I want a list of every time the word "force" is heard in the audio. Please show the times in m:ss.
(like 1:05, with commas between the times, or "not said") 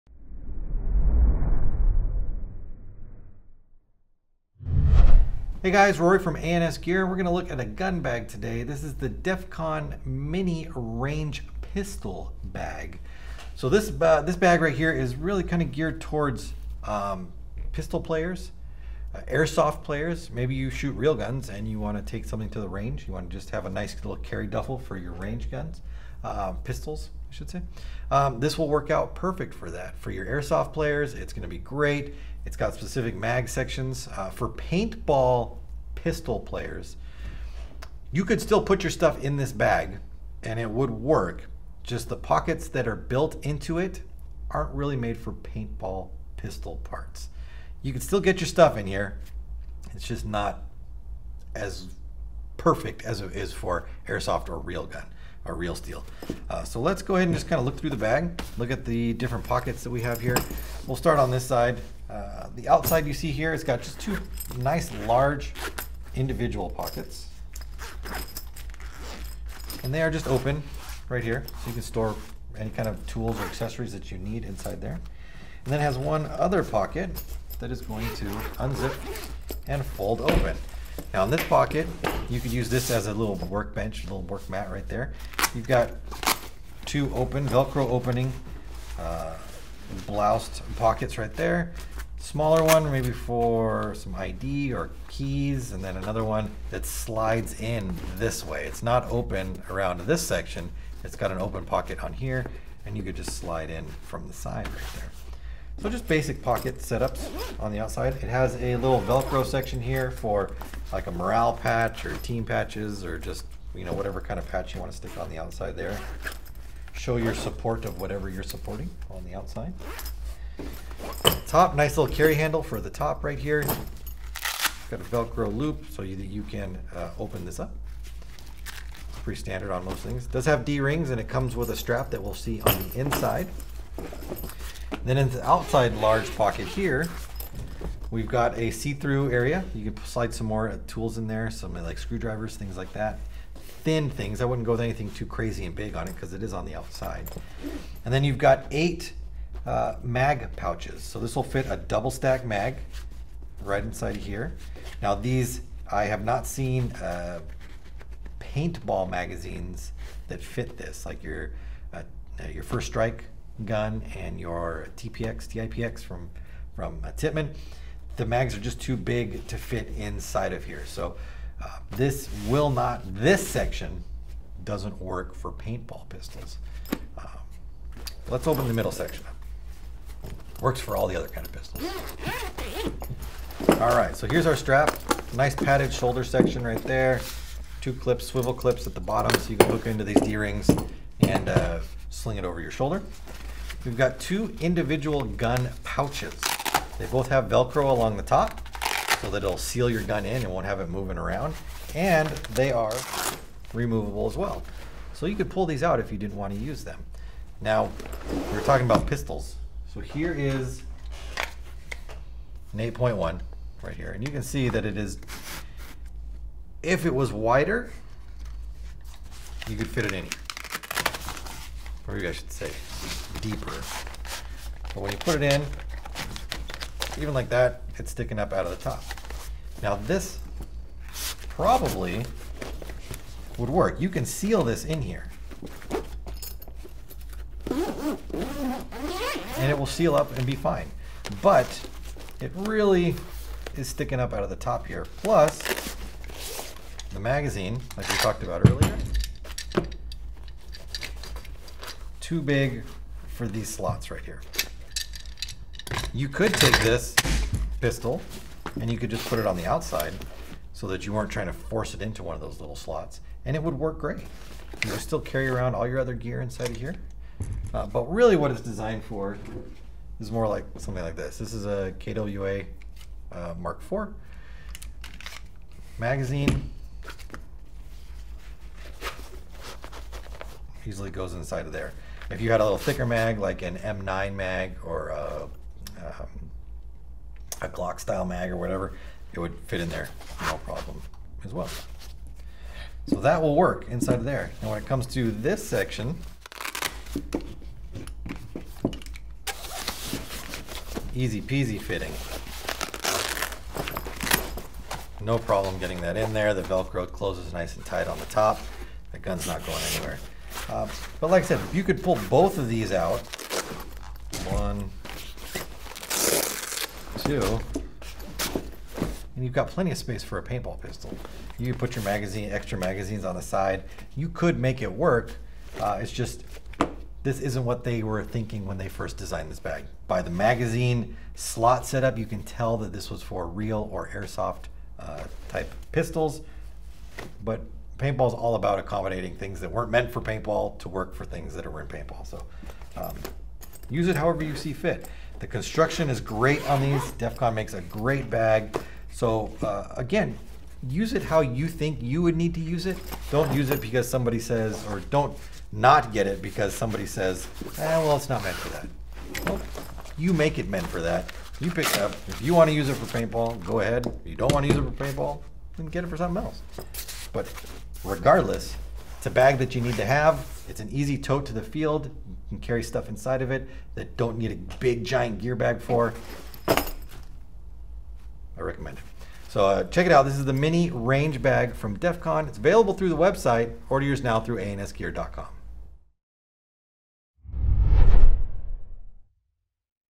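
4:21.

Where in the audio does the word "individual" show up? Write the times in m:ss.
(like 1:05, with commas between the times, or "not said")
1:06, 3:14.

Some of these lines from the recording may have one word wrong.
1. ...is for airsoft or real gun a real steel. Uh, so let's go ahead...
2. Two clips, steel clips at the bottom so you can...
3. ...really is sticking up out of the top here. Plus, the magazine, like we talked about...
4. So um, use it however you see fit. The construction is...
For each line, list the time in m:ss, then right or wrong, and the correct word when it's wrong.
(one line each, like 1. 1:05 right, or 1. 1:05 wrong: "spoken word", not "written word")
1. 0:53 right
2. 3:07 wrong: "swivel", not "steel"
3. 4:02 right
4. 5:42 right.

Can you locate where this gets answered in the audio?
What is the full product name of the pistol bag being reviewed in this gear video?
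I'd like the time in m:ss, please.
0:09.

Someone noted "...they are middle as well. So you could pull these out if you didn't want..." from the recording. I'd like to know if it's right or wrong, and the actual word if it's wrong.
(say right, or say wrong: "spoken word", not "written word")
wrong: "removable", not "middle".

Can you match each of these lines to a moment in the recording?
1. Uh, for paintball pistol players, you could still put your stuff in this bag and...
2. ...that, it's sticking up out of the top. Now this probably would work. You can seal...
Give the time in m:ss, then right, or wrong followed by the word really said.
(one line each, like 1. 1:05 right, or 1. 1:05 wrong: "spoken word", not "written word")
1. 0:34 right
2. 3:47 right.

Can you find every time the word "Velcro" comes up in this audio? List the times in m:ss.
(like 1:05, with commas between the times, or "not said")
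1:27, 1:49, 2:05, 3:17, 5:06.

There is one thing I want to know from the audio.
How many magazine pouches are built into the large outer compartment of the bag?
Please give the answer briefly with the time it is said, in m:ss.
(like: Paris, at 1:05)
8, at 2:28.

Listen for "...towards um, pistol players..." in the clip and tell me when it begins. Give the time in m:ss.
0:16.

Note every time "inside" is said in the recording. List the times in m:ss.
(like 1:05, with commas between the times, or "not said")
1:14, 2:12, 2:33, 2:49, 4:26, 4:41, 4:53, 6:13.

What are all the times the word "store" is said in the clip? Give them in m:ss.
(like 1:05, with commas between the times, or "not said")
1:11.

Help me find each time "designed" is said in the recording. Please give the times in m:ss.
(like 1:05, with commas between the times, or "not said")
4:28, 5:29.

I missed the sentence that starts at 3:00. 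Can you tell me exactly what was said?
Works for all the other kind of pistols.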